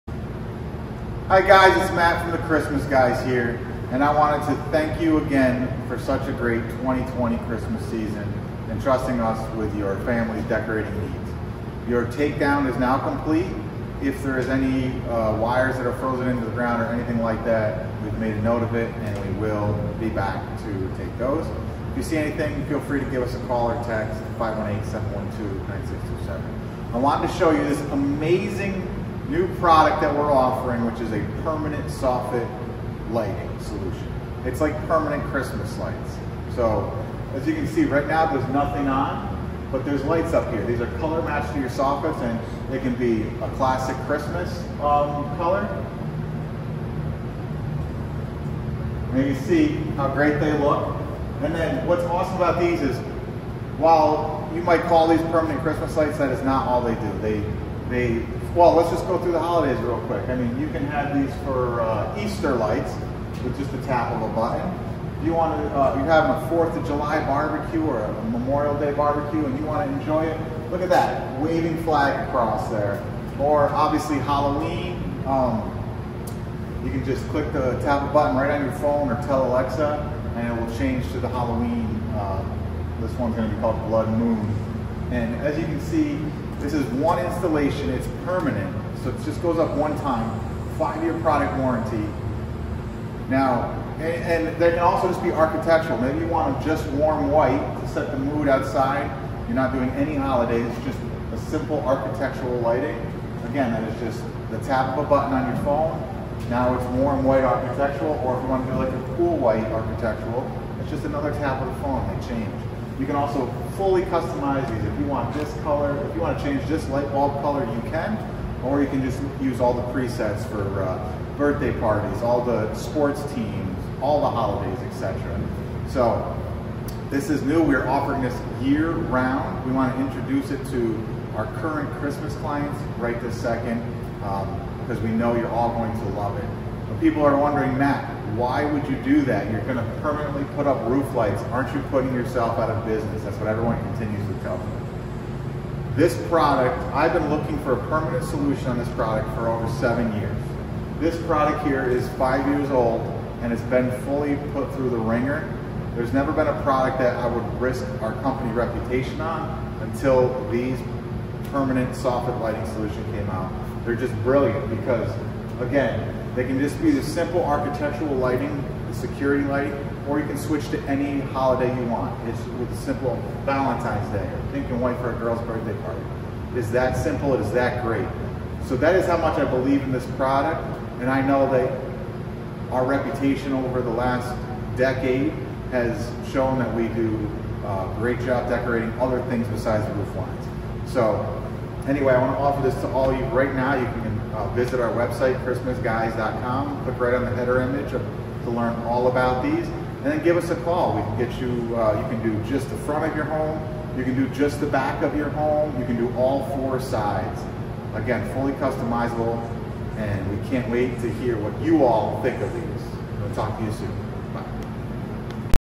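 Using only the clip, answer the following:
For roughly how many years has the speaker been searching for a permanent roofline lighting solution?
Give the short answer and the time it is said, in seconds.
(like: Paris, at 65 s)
Over 7 years, at 149 s.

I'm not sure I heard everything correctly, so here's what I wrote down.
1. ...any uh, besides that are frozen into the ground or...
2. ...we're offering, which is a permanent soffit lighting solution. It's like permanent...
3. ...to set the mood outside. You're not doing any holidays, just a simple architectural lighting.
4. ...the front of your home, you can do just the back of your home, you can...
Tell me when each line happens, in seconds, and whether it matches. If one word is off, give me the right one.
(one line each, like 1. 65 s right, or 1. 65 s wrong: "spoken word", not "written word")
1. 14 s wrong: "wires", not "besides"
2. 30 s right
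3. 97 s right
4. 202 s right.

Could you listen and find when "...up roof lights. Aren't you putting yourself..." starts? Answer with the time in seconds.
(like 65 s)
140 s.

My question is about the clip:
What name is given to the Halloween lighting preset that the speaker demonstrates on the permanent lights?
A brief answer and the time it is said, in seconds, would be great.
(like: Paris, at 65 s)
Blood Moon, at 83 s.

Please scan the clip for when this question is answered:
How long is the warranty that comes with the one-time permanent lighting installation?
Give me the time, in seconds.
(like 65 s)
90 s.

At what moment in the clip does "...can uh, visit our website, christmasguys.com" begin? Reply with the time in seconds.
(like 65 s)
193 s.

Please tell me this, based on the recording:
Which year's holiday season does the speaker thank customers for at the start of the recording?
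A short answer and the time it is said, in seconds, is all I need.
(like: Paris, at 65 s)
2020, at 6 s.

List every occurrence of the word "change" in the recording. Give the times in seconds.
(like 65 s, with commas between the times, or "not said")
80 s, 112 s, 116 s.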